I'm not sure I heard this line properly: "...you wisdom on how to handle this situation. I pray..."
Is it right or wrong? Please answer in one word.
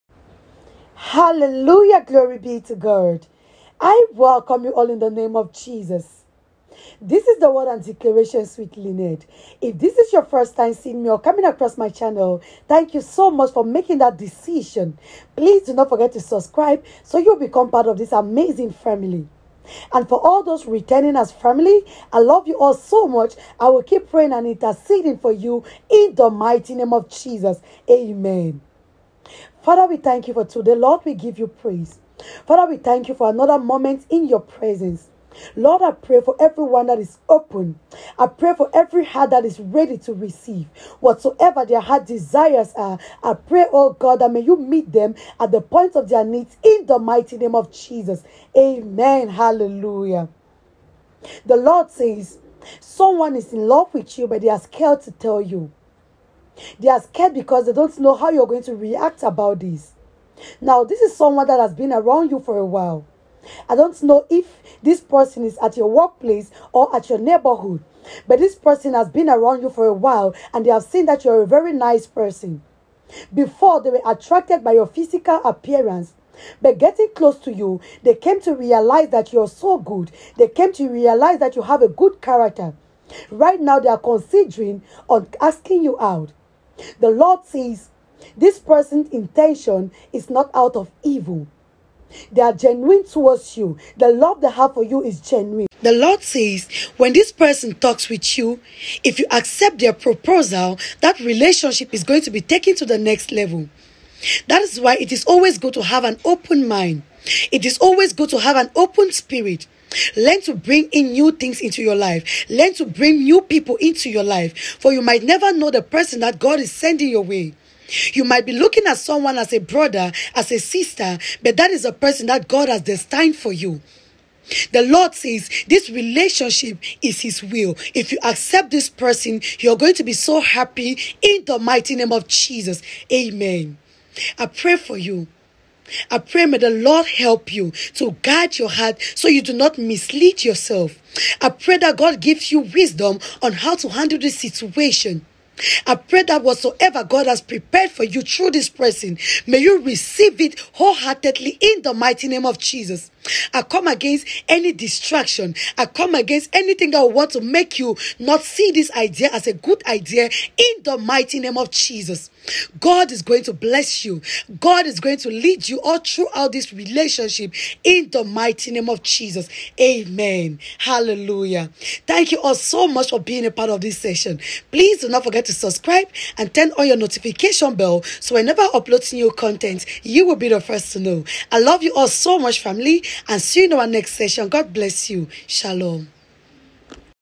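right.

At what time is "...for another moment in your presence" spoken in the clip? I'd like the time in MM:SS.
00:33.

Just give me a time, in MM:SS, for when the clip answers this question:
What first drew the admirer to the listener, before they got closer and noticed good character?
01:14.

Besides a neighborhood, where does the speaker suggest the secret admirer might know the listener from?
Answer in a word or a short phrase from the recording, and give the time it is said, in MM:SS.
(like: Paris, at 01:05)
Workplace, at 01:05.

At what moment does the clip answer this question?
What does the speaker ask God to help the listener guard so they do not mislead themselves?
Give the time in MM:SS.
02:18.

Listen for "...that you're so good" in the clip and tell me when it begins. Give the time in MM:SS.
01:19.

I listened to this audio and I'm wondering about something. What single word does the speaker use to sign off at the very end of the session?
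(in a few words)
Shalom.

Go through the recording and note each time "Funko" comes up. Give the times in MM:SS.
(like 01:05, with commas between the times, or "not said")
not said.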